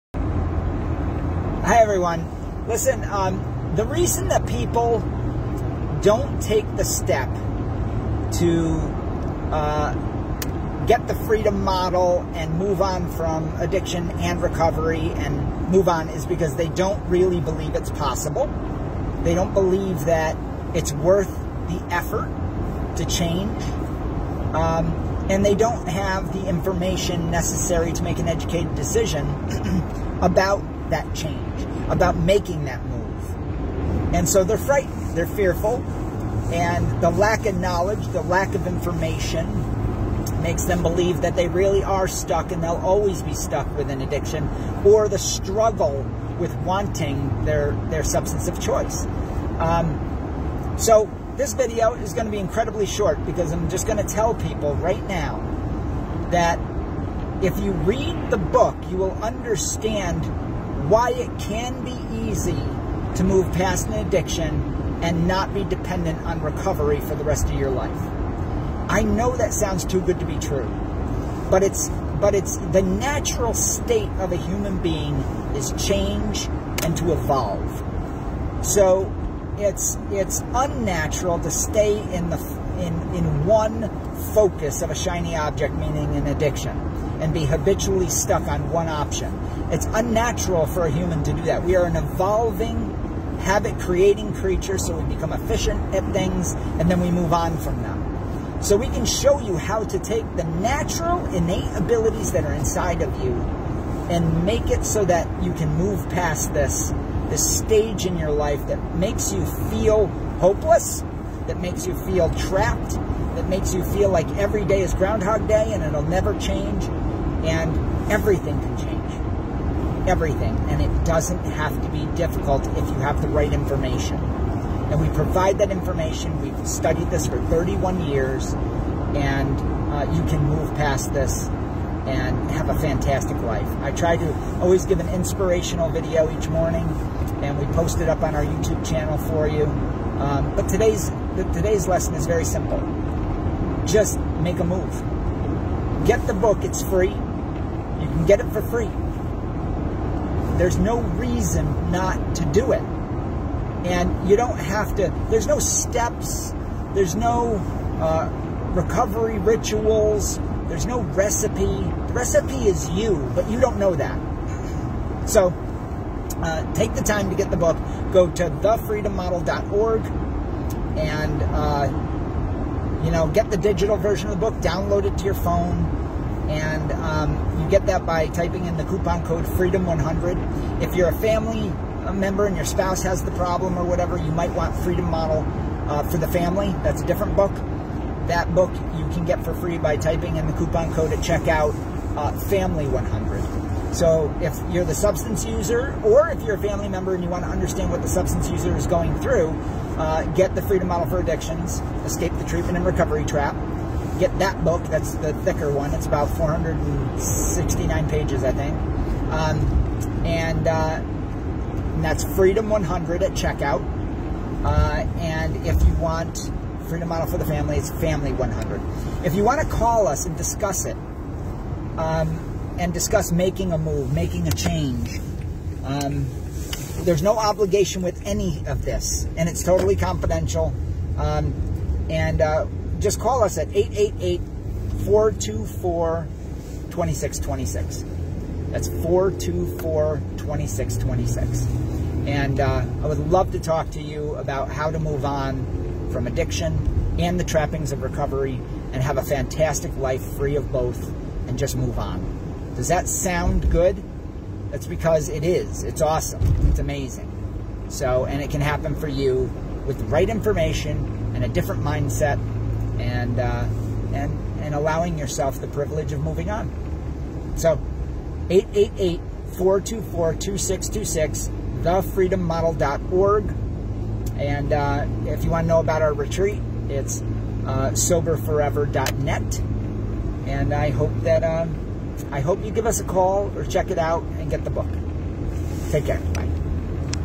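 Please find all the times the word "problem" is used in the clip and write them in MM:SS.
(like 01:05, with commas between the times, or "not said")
03:03.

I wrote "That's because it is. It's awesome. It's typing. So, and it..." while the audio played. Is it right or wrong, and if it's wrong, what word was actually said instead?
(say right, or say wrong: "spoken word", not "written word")
wrong: "amazing", not "typing".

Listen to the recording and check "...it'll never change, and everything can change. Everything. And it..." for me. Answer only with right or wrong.
right.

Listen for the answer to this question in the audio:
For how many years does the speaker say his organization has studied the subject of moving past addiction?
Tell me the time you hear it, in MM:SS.
02:07.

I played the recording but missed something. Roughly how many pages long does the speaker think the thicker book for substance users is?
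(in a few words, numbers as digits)
469.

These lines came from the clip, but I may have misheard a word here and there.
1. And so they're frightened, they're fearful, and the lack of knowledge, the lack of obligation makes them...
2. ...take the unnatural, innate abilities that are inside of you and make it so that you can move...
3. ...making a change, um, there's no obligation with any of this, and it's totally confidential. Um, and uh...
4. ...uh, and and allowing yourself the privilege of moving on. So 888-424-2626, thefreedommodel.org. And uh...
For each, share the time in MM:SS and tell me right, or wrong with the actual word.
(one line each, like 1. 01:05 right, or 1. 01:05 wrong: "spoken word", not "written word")
1. 00:34 wrong: "information", not "obligation"
2. 01:39 wrong: "natural", not "unnatural"
3. 03:44 right
4. 04:23 right.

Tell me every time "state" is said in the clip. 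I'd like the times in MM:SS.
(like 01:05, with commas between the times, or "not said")
01:13.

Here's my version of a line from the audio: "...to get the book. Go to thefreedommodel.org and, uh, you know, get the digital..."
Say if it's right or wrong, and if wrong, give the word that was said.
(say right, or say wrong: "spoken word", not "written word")
right.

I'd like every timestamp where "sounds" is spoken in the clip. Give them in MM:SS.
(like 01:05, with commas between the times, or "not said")
01:09, 04:13.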